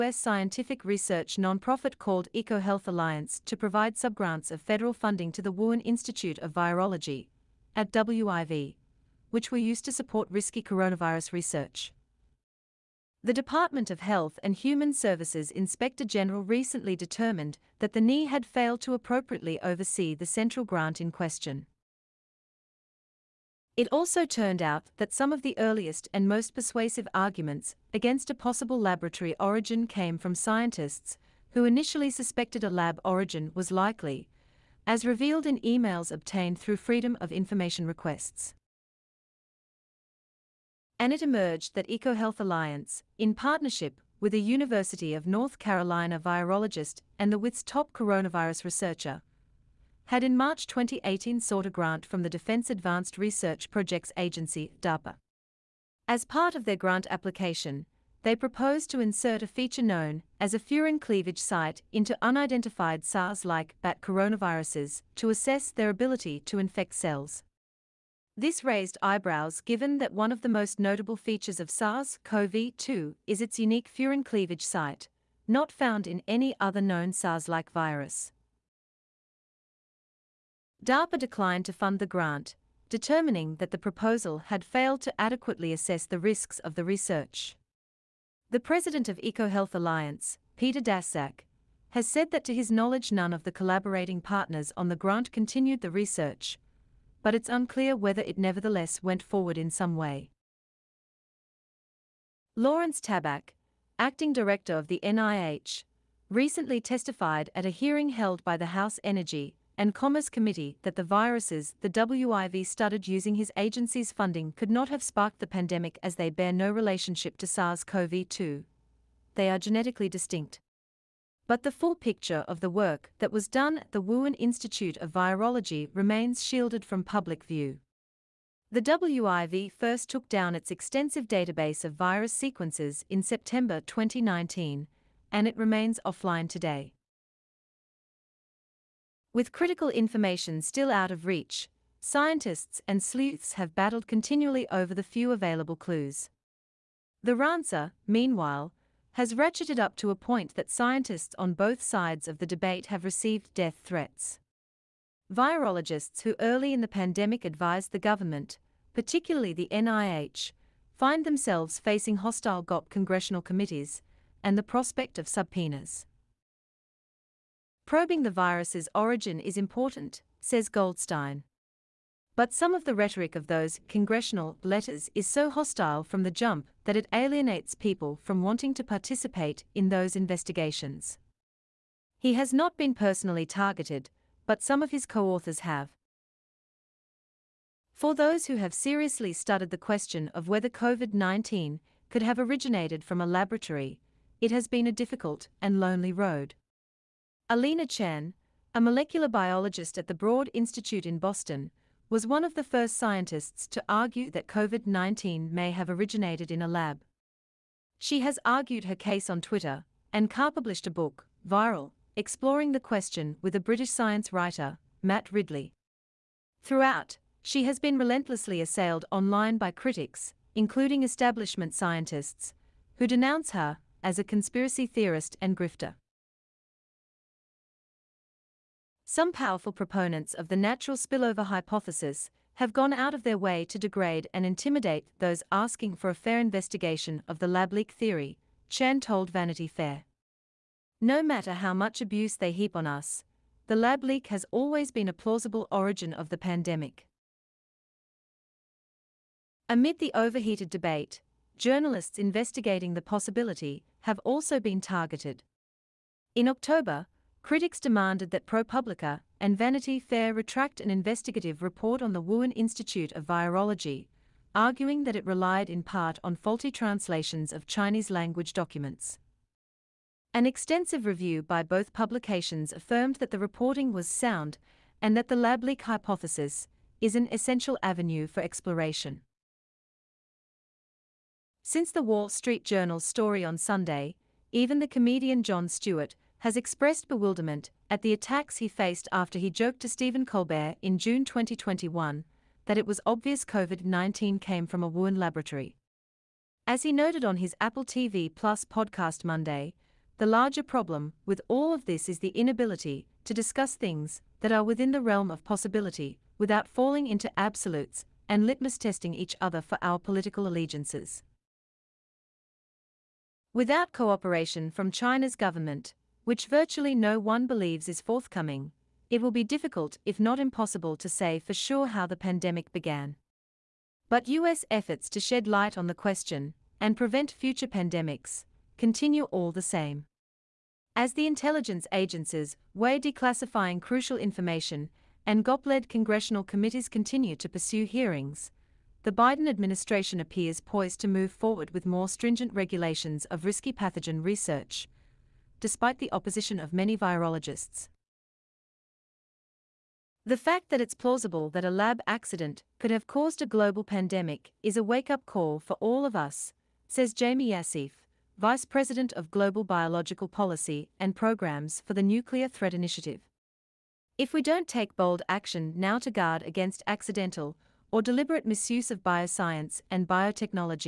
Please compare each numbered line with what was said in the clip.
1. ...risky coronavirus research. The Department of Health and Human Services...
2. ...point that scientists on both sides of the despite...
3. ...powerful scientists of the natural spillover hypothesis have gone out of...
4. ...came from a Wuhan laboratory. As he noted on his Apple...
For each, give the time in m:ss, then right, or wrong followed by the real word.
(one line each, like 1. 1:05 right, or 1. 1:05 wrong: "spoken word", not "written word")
1. 0:10 right
2. 2:30 wrong: "debate", not "despite"
3. 3:49 wrong: "proponents", not "scientists"
4. 4:54 right.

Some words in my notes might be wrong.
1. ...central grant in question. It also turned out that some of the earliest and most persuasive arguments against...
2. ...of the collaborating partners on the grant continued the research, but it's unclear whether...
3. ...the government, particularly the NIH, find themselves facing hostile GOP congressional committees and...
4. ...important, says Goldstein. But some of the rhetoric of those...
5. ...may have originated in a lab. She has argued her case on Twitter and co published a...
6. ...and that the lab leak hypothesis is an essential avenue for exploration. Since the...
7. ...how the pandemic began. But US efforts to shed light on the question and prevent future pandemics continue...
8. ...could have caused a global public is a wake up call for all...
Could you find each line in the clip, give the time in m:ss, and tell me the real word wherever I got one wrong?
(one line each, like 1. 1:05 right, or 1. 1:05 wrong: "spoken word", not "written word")
1. 0:20 right
2. 1:33 right
3. 2:37 right
4. 2:49 right
5. 3:25 right
6. 4:35 right
7. 5:21 right
8. 5:52 wrong: "pandemic", not "public".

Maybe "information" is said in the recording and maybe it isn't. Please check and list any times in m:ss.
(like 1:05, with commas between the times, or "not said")
0:37, 2:19, 5:34.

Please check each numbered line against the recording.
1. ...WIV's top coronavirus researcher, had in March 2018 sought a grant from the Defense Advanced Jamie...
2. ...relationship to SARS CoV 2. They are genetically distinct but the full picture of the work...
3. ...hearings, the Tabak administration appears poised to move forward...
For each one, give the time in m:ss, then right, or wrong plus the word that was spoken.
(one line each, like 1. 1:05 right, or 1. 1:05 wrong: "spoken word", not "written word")
1. 0:47 wrong: "Research", not "Jamie"
2. 1:56 right
3. 5:37 wrong: "Biden", not "Tabak".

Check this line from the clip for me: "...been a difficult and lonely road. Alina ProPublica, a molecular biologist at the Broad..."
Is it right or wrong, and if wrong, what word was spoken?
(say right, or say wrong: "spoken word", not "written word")
wrong: "Chan", not "ProPublica".